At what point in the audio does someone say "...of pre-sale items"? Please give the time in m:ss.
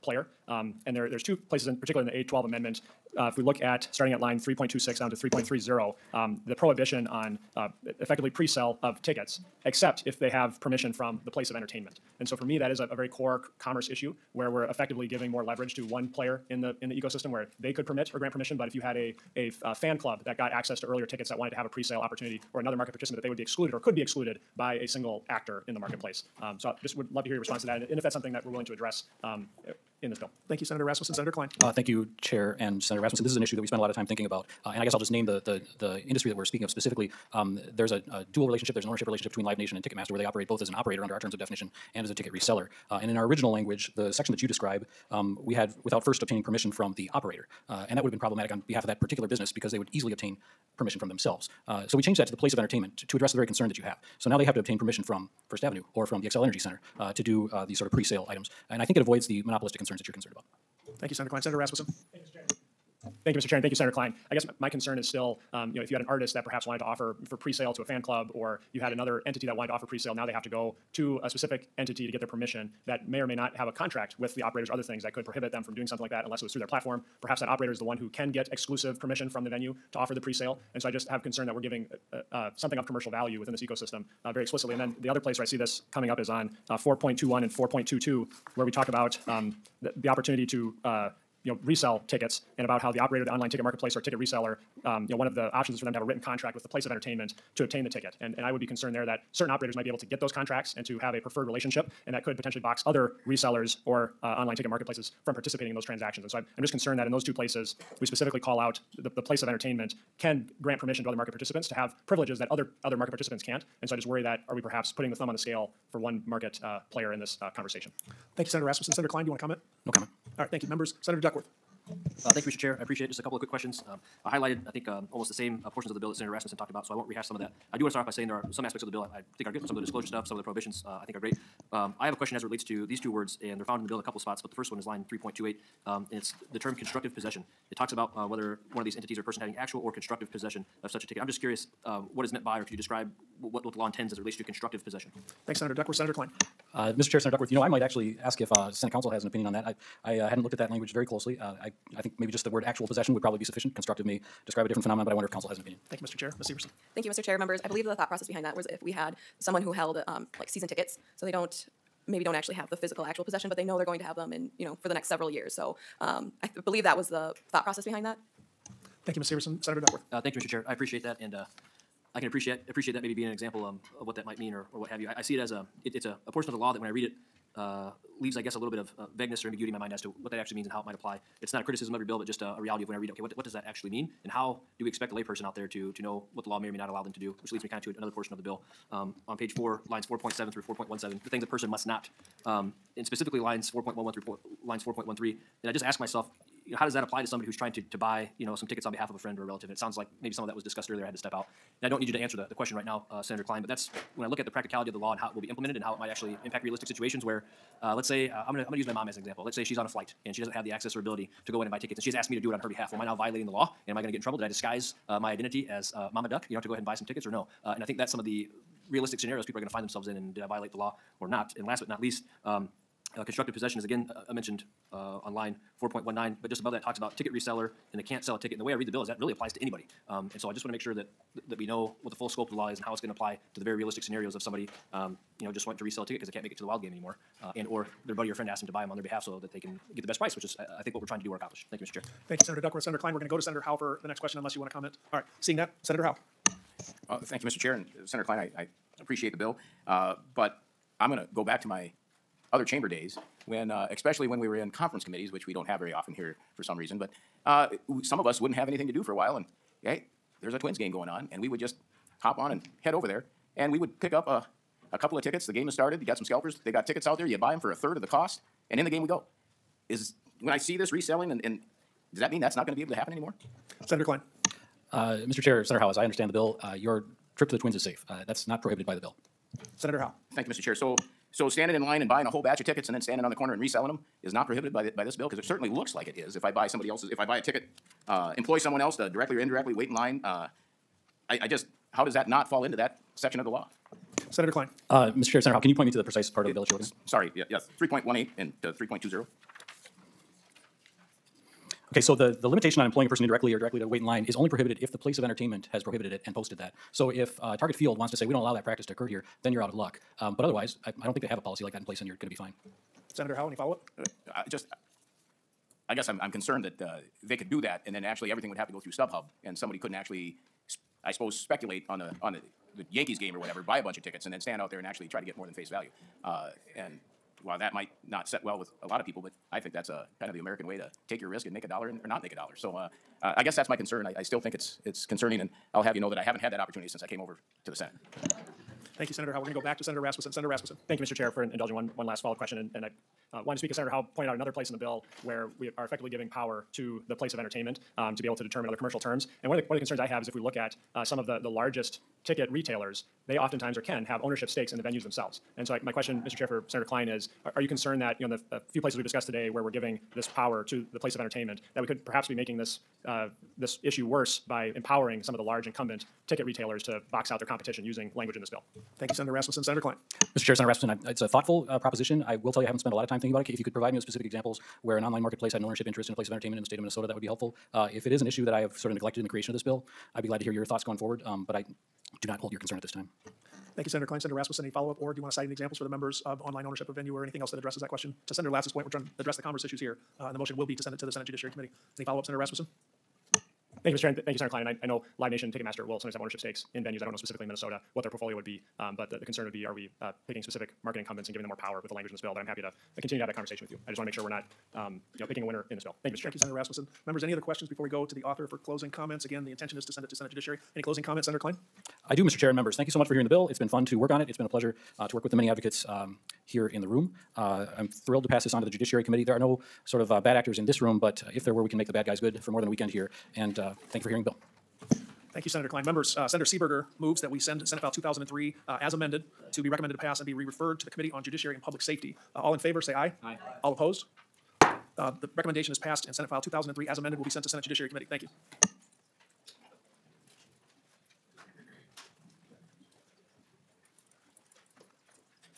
0:57.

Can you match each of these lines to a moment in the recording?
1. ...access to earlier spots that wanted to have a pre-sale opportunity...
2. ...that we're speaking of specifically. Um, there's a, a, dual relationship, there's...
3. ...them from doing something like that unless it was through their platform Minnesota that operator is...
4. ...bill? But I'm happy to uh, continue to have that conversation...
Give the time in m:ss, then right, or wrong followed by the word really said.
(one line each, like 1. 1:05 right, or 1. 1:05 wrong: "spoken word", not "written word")
1. 0:20 wrong: "tickets", not "spots"
2. 0:36 right
3. 1:15 wrong: "Perhaps", not "Minnesota"
4. 6:42 right.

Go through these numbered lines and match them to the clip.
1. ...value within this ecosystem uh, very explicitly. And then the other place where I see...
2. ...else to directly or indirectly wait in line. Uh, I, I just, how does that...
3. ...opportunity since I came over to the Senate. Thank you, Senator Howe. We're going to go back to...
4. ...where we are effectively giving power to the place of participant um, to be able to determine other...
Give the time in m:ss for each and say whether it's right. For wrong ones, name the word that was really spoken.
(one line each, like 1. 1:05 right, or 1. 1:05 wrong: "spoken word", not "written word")
1. 1:23 right
2. 4:48 right
3. 5:36 right
4. 5:45 wrong: "entertainment", not "participant".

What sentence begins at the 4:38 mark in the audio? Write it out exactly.
Uh, that's not prohibited by the bill.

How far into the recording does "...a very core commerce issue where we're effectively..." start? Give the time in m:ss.
0:12.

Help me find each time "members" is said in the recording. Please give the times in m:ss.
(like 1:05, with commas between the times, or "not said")
2:00, 2:37, 6:25, 6:47, 6:52, 7:05.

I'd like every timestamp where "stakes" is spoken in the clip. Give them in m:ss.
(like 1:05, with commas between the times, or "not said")
5:54, 6:36.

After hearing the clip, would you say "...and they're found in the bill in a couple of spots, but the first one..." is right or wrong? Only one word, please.
right.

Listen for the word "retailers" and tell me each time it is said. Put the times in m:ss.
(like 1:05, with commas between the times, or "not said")
5:52, 6:06.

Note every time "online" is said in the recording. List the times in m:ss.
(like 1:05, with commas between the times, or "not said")
1:33, 1:44, 6:15, 6:26.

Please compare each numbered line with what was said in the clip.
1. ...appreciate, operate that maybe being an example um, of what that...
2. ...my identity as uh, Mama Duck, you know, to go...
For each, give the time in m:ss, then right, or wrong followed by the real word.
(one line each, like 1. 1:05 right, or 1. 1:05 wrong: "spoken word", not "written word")
1. 2:52 wrong: "appreciate", not "operate"
2. 3:35 right.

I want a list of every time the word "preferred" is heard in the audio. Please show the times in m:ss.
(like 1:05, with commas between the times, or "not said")
1:41.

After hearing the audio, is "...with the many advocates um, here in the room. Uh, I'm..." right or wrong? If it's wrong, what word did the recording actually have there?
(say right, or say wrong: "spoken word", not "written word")
right.